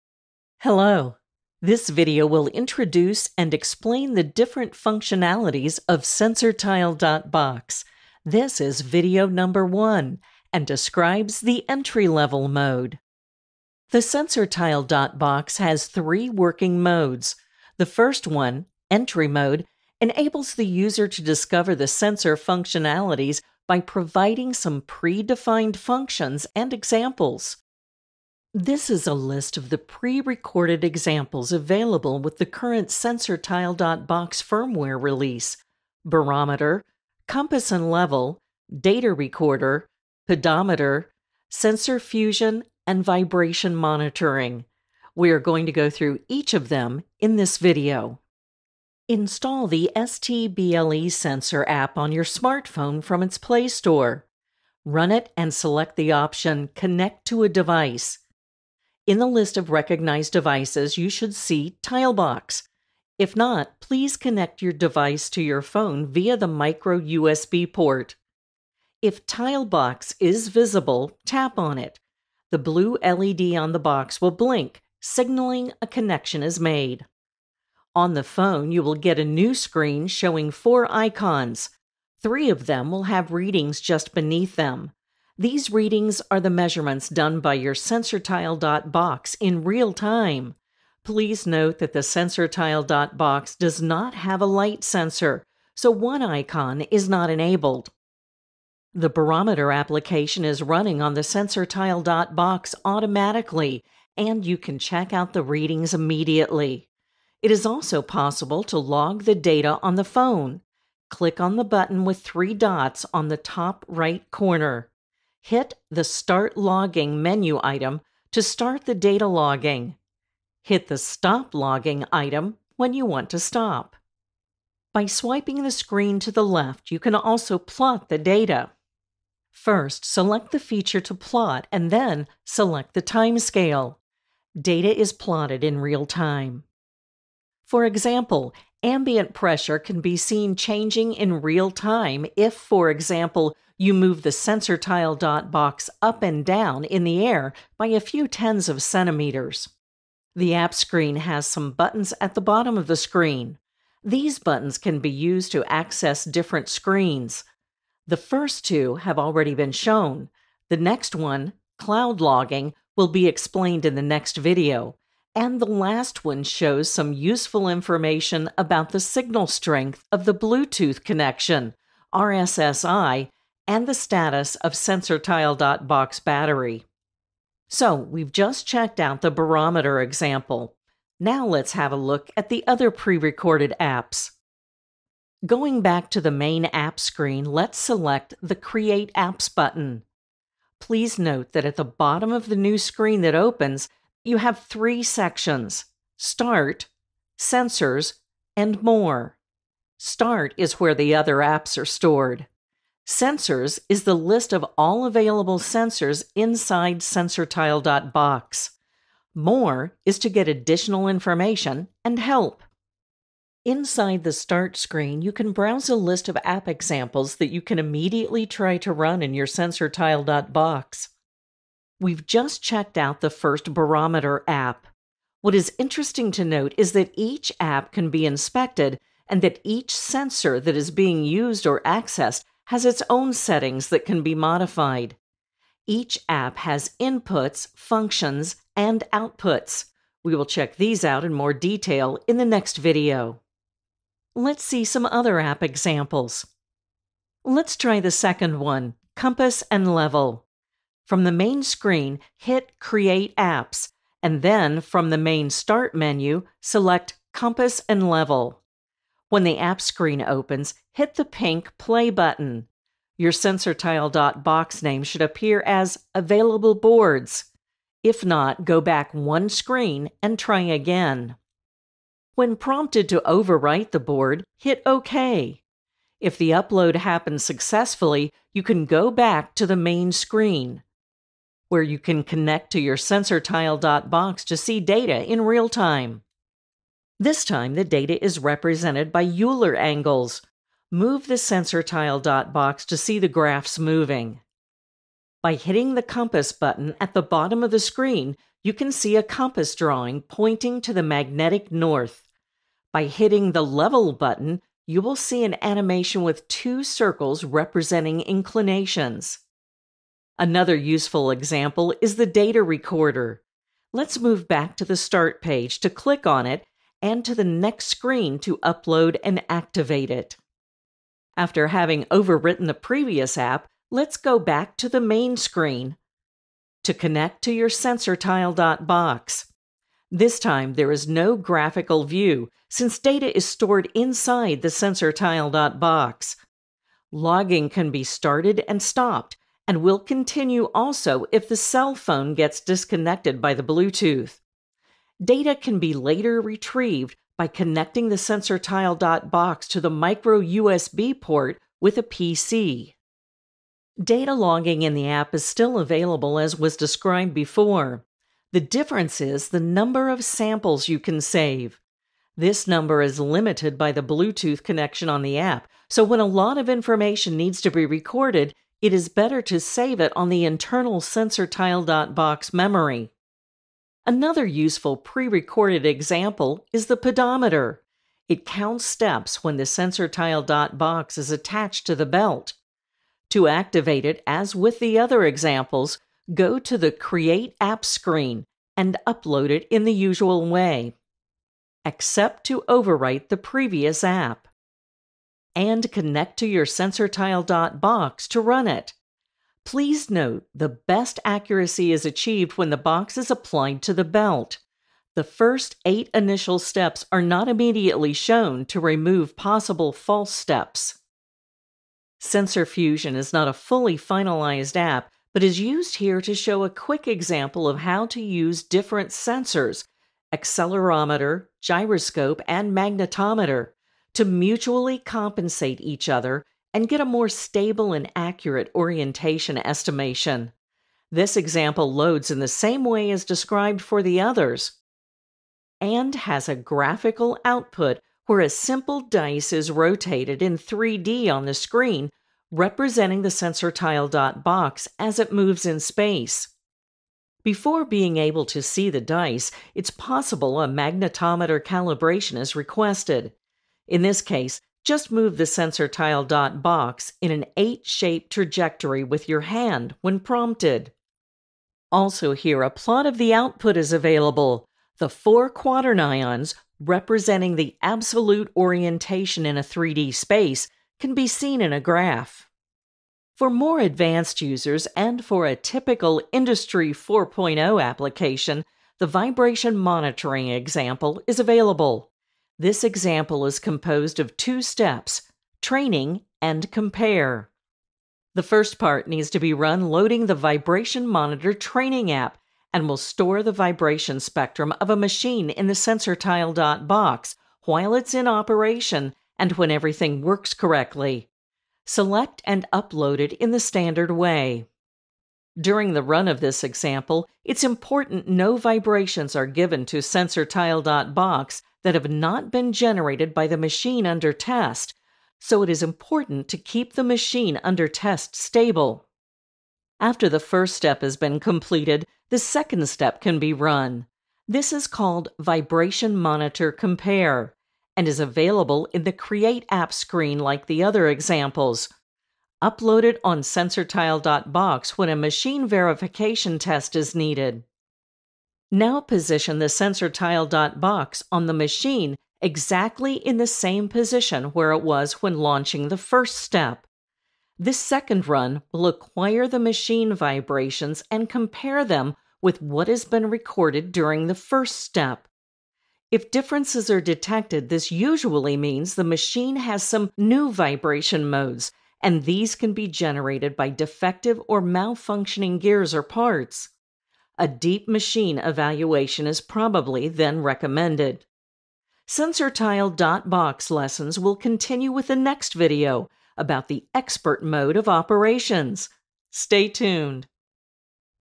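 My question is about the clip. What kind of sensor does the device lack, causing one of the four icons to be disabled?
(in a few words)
light sensor.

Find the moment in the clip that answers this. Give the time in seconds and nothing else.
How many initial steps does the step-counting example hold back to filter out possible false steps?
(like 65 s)
405 s.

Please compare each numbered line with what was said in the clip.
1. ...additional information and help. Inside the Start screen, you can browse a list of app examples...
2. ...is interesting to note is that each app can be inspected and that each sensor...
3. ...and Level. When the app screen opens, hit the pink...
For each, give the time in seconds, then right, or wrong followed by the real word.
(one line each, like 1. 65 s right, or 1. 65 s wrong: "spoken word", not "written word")
1. 210 s right
2. 225 s right
3. 257 s right.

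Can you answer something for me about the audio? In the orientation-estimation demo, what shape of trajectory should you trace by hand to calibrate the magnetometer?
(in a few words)
8-shaped.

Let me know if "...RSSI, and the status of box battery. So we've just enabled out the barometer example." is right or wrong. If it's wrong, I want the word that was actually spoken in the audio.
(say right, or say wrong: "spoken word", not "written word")
wrong: "checked", not "enabled".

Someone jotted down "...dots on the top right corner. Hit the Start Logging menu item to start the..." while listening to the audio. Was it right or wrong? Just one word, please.
right.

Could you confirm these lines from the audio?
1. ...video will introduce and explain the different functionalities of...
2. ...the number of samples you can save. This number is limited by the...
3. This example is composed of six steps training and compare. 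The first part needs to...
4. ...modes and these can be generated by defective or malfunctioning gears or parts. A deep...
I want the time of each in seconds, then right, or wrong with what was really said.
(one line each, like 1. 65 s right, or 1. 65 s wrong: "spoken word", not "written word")
1. 1 s right
2. 359 s right
3. 482 s wrong: "two", not "six"
4. 561 s right.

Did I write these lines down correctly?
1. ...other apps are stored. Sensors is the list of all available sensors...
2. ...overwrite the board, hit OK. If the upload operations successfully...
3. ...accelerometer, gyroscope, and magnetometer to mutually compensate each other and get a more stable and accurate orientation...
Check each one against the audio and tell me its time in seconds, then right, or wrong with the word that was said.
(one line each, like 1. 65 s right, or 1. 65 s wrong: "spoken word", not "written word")
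1. 201 s right
2. 273 s wrong: "happens", not "operations"
3. 420 s right.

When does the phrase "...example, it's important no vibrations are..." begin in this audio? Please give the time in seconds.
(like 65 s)
506 s.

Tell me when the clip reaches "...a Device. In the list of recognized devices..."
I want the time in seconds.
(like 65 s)
57 s.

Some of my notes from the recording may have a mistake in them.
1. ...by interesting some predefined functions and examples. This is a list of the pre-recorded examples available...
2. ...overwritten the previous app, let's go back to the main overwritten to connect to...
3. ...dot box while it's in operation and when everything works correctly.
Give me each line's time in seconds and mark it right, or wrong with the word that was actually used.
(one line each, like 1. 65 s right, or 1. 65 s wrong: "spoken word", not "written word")
1. 23 s wrong: "providing", not "interesting"
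2. 322 s wrong: "screen", not "overwritten"
3. 496 s right.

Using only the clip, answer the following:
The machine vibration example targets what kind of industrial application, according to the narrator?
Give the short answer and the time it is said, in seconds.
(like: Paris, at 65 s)
Industry 4.0, at 476 s.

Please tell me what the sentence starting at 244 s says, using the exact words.
Let's see some other app examples.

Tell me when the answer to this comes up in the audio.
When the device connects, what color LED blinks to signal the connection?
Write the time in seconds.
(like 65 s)
72 s.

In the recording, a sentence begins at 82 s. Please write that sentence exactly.
Three of them will have readings just beneath them.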